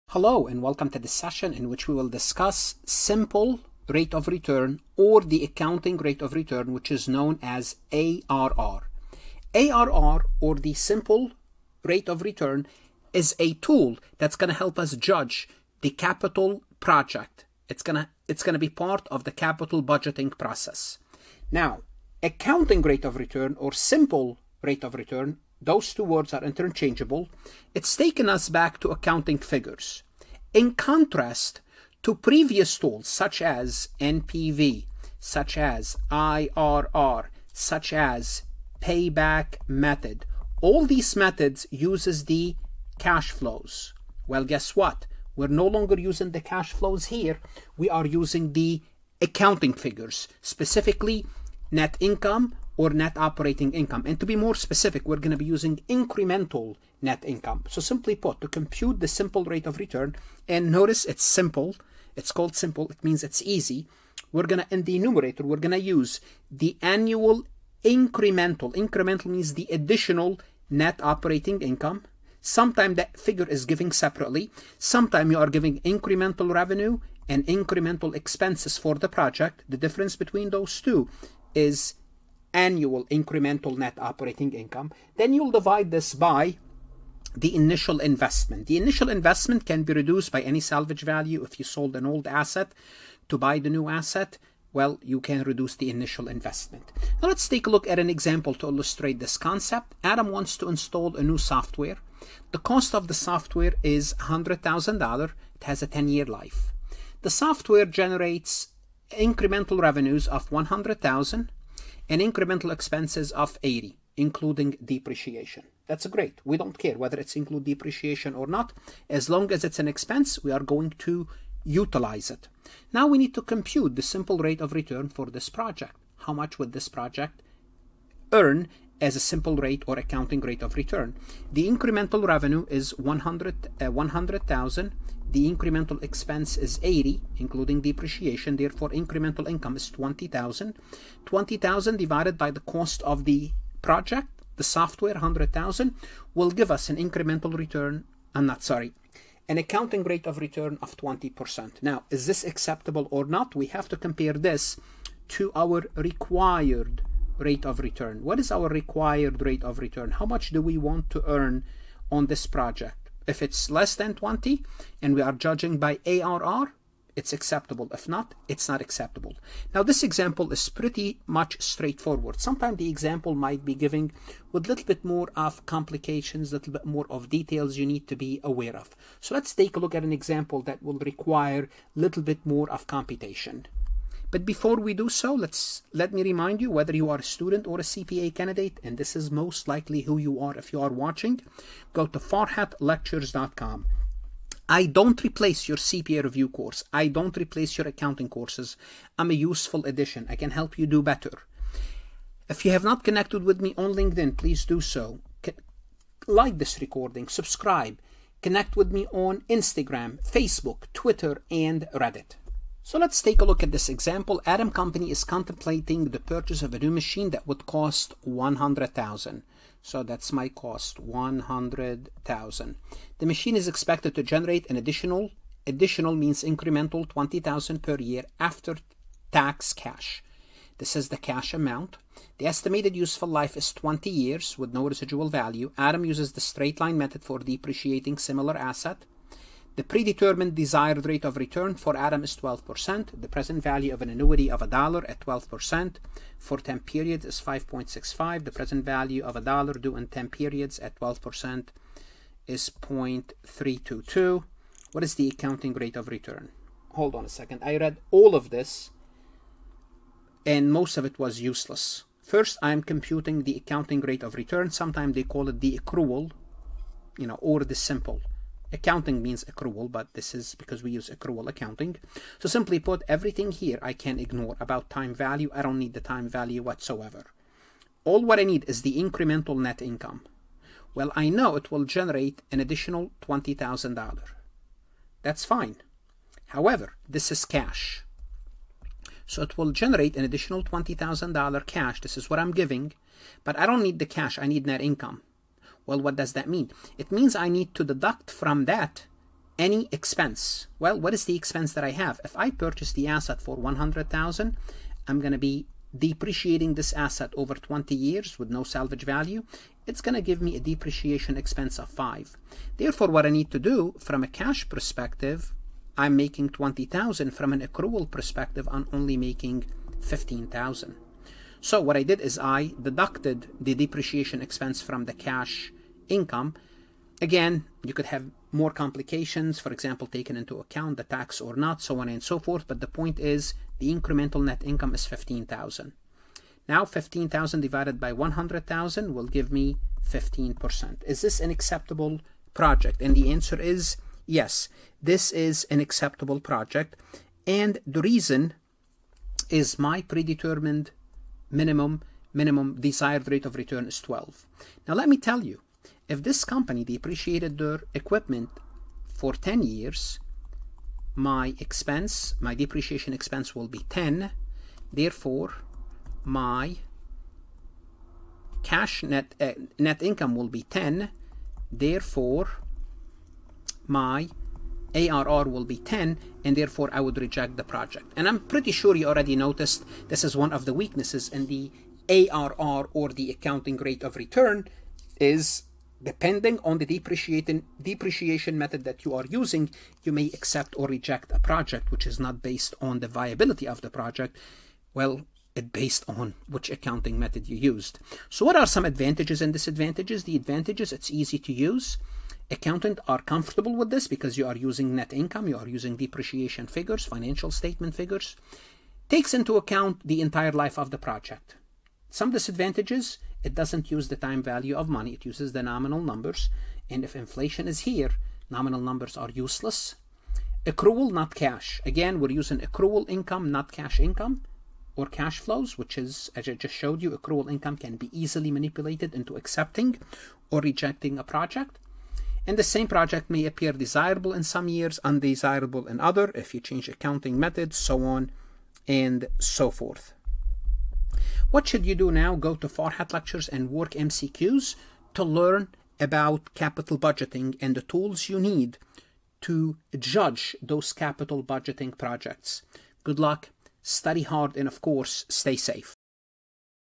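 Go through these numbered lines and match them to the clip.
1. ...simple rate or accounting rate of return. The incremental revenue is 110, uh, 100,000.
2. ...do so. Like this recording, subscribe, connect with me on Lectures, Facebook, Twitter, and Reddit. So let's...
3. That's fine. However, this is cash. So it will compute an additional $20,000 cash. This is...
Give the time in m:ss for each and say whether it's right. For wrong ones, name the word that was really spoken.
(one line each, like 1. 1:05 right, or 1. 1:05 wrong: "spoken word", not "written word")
1. 2:09 wrong: "100", not "110"
2. 3:24 wrong: "Instagram", not "Lectures"
3. 4:45 wrong: "generate", not "compute".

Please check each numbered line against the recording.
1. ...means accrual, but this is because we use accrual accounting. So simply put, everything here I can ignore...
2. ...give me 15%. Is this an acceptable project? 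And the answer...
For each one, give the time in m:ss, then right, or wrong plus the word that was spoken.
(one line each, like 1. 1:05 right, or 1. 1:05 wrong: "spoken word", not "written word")
1. 4:29 right
2. 5:39 right.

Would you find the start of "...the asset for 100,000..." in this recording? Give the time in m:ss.
5:02.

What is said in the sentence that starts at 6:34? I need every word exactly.
Well, it based on which accounting method you used.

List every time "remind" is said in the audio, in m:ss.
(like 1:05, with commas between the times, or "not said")
3:06.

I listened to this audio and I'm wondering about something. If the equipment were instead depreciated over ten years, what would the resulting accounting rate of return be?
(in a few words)
10%.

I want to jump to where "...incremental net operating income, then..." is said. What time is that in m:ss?
1:23.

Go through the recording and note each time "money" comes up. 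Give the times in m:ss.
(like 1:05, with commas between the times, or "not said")
6:54.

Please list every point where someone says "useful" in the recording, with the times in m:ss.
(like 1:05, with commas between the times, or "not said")
3:19, 3:52.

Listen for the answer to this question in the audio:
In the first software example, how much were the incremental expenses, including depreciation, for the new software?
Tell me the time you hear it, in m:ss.
1:52.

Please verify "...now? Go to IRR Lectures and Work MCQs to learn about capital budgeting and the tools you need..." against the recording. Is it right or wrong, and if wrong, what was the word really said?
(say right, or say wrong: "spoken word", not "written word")
wrong: "Farhat", not "IRR".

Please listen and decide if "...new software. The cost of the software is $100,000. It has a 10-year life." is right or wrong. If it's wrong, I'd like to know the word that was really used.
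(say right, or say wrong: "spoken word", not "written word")
right.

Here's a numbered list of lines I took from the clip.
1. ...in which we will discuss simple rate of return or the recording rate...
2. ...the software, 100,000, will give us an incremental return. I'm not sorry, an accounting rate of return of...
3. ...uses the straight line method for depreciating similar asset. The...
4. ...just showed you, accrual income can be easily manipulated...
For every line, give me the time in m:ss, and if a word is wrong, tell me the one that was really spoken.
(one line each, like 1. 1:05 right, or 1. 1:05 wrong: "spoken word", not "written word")
1. 0:01 wrong: "accounting", not "recording"
2. 2:24 right
3. 3:56 right
4. 7:06 right.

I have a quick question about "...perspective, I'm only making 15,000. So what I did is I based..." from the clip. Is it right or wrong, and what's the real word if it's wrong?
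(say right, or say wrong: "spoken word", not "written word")
wrong: "deducted", not "based".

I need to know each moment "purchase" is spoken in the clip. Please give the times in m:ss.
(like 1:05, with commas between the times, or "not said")
3:36, 5:02.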